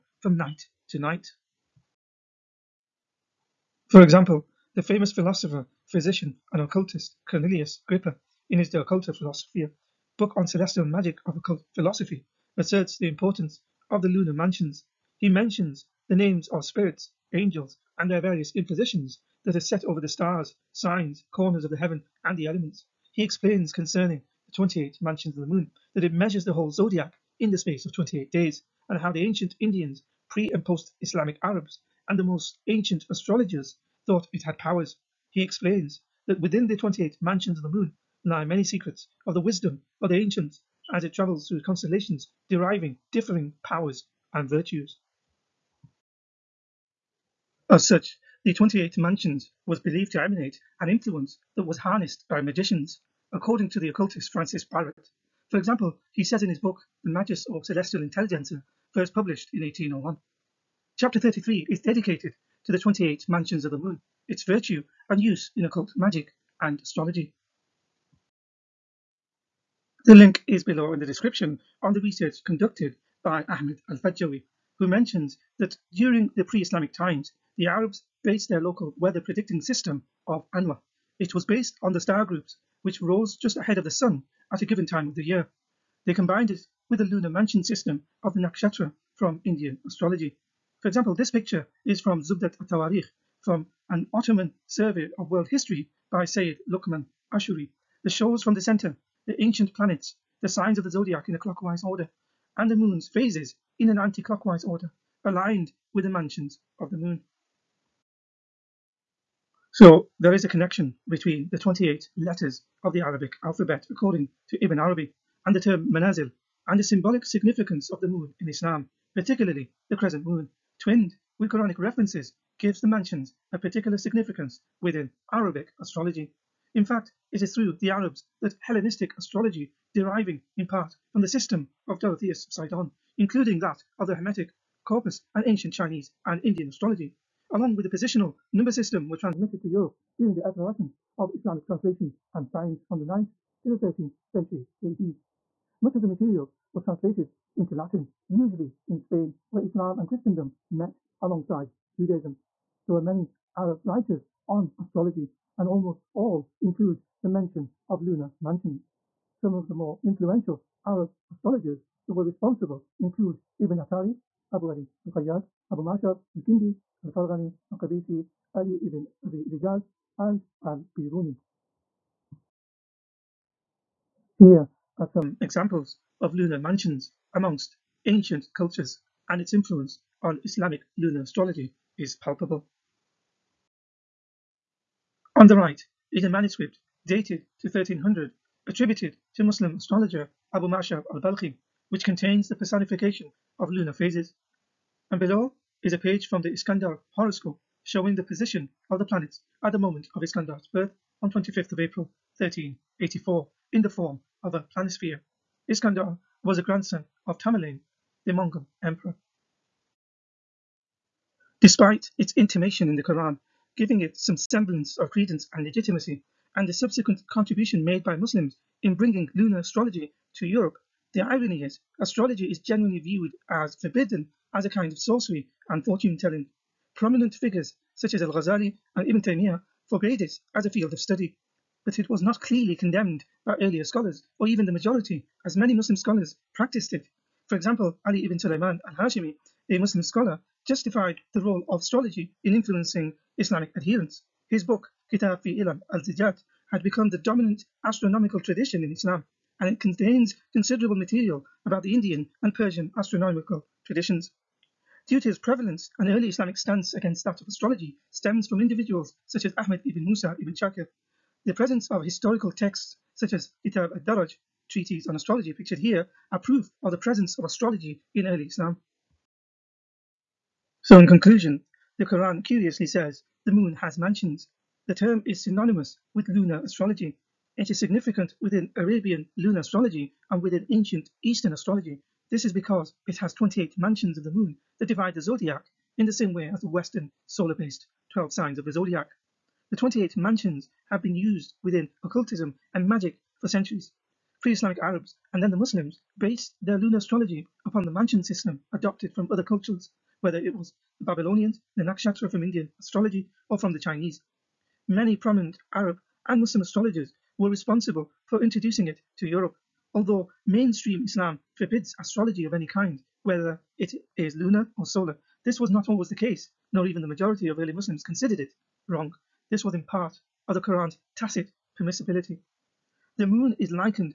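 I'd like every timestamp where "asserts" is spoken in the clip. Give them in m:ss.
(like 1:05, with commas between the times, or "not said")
0:12.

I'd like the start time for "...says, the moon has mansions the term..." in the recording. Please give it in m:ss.
4:32.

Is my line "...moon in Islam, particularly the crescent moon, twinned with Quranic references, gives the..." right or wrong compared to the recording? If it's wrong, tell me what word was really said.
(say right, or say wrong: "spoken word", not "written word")
right.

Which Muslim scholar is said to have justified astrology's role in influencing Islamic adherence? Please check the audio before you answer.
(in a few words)
Ali ibn Sulayman al-Hashimi.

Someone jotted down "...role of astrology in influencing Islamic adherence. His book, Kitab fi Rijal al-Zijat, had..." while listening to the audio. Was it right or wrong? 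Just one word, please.
wrong.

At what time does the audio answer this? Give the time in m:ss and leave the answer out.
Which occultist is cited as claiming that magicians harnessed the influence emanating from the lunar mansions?
0:54.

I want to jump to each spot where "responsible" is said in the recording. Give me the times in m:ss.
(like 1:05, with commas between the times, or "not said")
2:42, 5:07.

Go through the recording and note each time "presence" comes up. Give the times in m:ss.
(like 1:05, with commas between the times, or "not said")
4:21, 4:26.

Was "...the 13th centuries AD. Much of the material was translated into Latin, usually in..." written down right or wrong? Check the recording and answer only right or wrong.
right.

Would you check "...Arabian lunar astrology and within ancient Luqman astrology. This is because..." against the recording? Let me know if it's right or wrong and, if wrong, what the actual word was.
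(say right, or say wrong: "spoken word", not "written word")
wrong: "Eastern", not "Luqman".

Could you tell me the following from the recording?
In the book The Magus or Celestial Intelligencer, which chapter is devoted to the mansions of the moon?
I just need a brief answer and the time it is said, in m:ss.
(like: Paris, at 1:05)
Chapter 33, at 1:00.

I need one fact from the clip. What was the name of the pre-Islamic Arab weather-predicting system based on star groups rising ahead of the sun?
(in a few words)
Anwa.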